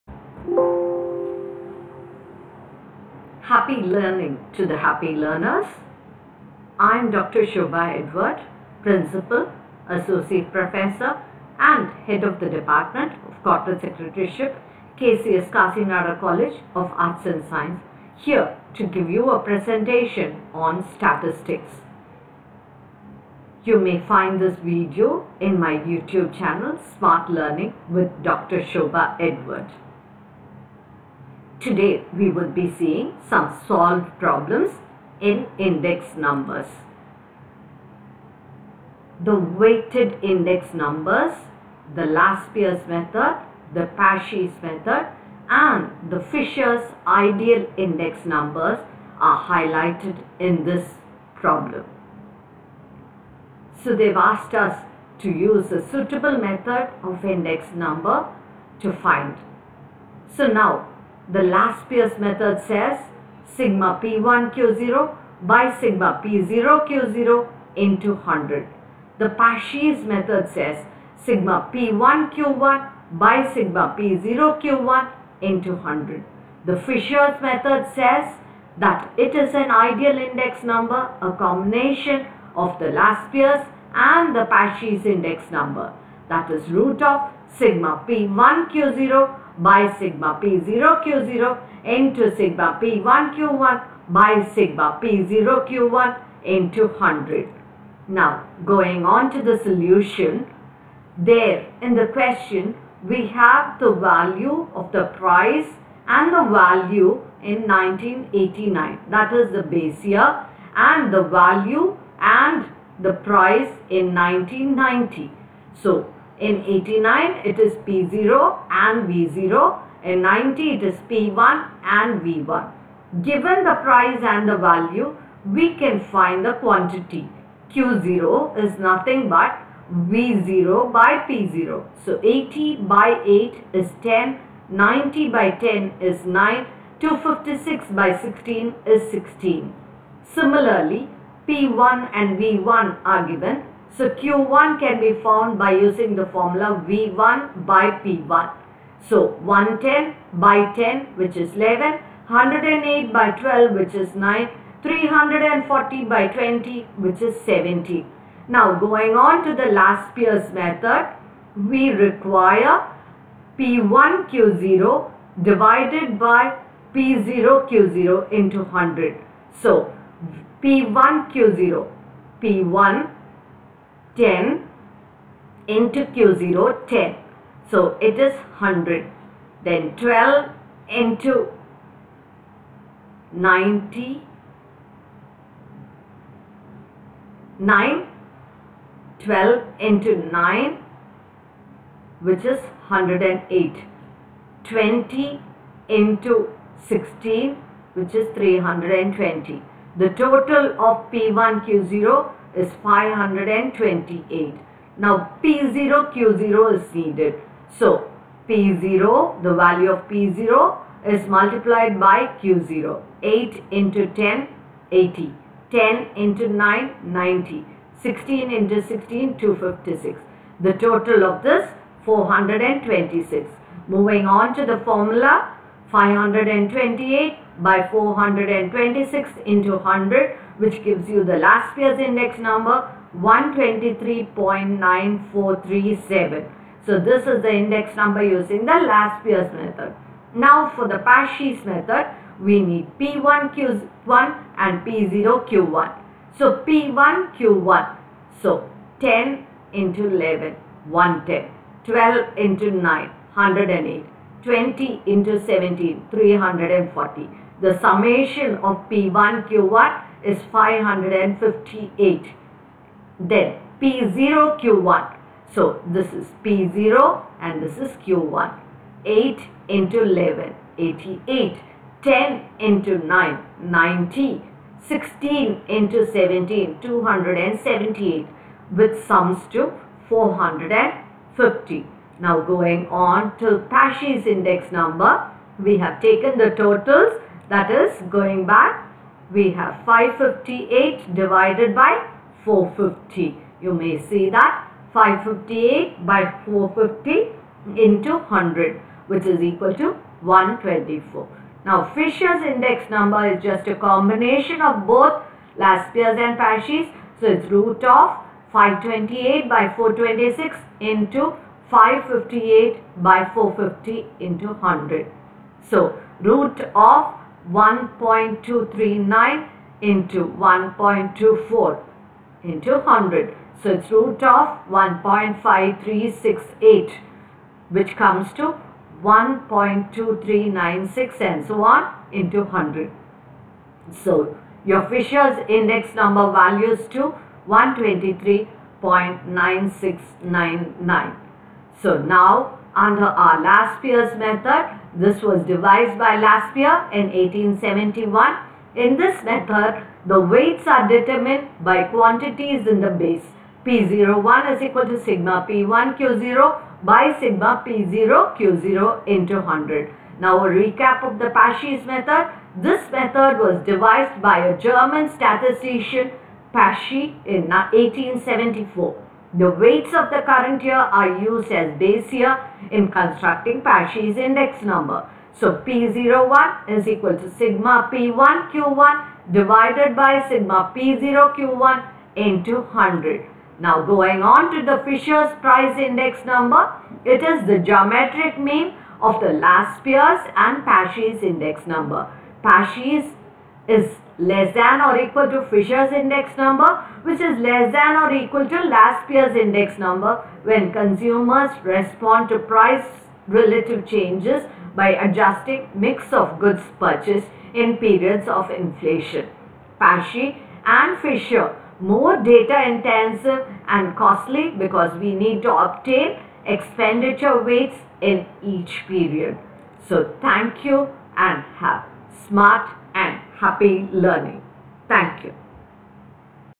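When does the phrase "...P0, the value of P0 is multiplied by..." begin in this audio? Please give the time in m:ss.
3:28.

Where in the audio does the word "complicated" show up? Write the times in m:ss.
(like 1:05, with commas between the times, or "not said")
not said.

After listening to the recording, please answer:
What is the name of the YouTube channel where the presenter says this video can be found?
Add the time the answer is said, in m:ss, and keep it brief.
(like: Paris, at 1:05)
Smart Learning with Dr. Shobha Edward, at 0:26.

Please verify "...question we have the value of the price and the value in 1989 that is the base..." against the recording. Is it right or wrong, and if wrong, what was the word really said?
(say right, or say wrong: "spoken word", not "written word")
right.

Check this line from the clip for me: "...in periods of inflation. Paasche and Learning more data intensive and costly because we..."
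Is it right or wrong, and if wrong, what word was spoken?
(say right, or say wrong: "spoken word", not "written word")
wrong: "Fisher", not "Learning".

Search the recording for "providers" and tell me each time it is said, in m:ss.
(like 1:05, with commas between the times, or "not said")
not said.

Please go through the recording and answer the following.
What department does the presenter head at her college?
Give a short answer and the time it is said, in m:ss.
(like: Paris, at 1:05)
Corporate Secretaryship, at 0:13.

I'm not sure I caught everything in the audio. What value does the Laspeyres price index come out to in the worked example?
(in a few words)
123.9437.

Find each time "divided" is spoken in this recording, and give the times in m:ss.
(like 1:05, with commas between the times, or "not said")
2:45, 4:51, 6:19.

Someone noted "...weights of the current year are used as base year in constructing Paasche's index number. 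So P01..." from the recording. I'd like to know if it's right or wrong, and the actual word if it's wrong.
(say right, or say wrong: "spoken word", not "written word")
right.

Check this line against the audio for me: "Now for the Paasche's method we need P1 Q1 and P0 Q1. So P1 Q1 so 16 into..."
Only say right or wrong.
wrong.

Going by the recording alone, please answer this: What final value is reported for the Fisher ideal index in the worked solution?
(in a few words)
123.9699.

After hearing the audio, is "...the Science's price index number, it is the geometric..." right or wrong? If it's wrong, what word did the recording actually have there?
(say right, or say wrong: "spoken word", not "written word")
wrong: "Fisher", not "Science".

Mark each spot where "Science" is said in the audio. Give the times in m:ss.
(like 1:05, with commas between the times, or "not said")
0:17.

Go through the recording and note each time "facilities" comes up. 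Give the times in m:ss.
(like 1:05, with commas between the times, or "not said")
not said.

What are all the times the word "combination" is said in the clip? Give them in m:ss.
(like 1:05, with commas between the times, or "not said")
1:21, 5:03.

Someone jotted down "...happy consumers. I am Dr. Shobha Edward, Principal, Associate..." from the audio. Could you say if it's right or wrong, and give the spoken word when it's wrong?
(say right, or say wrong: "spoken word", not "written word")
wrong: "learners", not "consumers".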